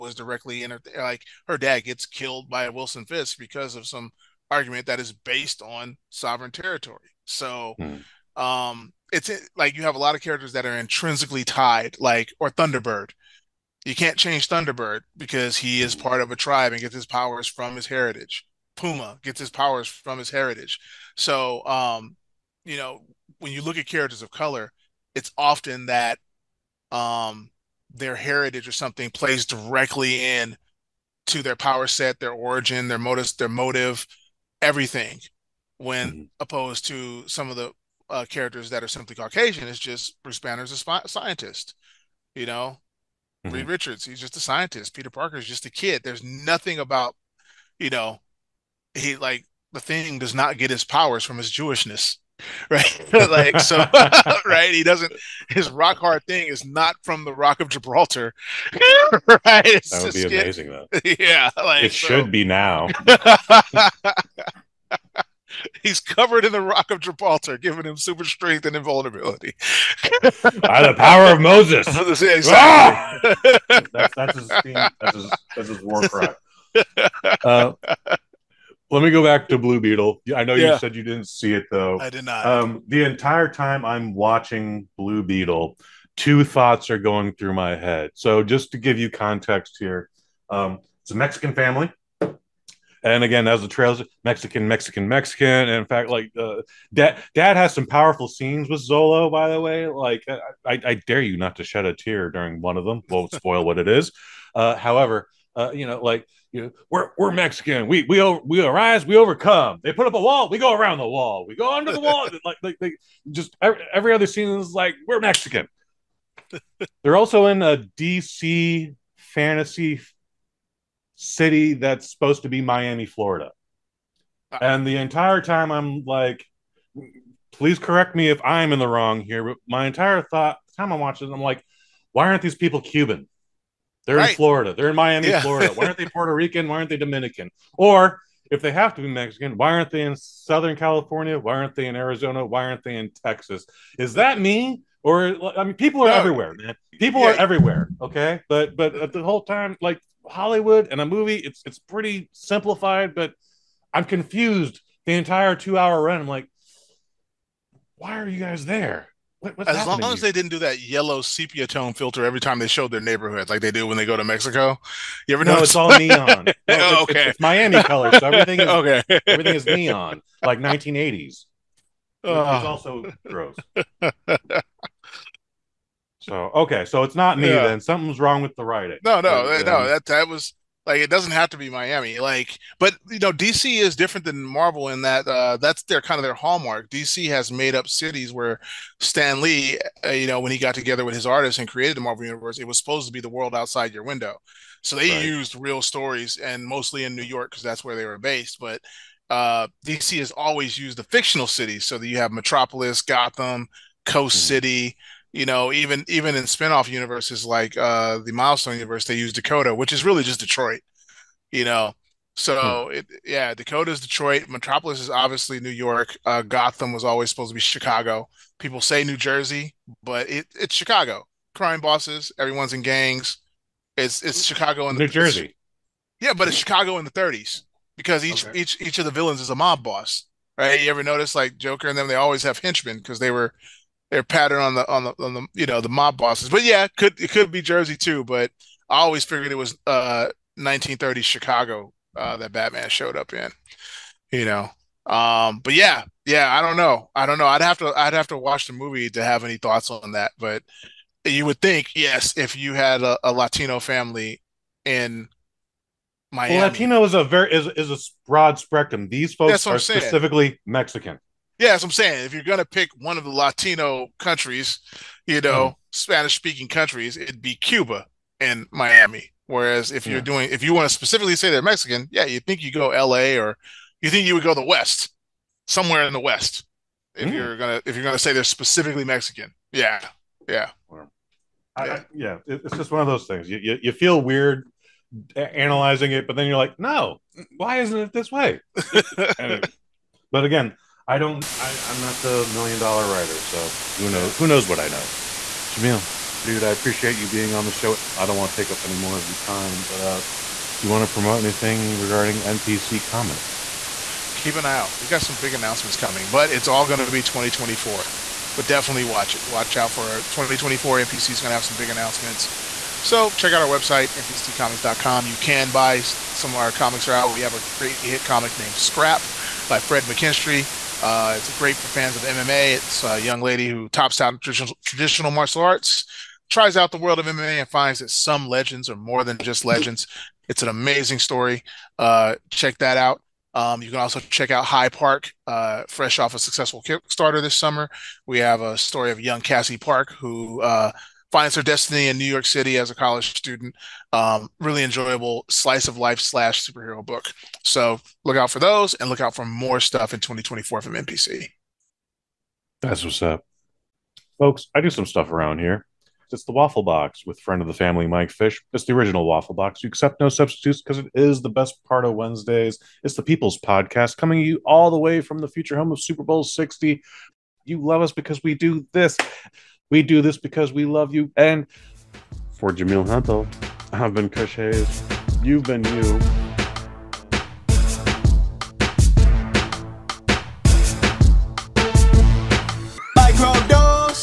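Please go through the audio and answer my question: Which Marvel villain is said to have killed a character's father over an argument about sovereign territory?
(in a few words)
Wilson Fisk.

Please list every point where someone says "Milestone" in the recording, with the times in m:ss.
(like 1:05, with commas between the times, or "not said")
3:28.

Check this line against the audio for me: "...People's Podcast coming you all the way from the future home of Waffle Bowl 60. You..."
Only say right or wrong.
wrong.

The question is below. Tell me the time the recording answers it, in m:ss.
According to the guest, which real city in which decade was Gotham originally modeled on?
4:00.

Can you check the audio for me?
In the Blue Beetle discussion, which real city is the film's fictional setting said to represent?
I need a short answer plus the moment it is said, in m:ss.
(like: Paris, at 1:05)
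Miami, Florida, at 2:02.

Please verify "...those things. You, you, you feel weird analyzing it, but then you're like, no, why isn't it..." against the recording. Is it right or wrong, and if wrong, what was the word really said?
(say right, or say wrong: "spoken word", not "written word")
right.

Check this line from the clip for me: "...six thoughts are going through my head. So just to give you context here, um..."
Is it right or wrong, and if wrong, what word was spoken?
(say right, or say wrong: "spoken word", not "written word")
wrong: "two", not "six".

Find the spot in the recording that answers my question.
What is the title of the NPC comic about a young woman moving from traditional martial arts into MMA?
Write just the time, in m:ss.
5:18.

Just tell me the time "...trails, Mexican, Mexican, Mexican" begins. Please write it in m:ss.
1:33.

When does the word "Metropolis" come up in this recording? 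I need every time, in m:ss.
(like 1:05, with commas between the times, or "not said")
3:22, 3:34.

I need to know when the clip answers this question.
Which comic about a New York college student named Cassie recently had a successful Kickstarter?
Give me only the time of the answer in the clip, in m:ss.
5:34.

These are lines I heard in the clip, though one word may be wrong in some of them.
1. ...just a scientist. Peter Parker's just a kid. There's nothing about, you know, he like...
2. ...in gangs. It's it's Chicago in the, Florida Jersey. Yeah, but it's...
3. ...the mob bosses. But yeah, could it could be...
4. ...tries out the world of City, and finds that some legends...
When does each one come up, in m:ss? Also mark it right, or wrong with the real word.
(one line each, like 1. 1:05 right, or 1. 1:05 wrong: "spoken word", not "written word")
1. 0:44 right
2. 3:42 wrong: "New", not "Florida"
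3. 3:55 right
4. 5:26 wrong: "MMA", not "City".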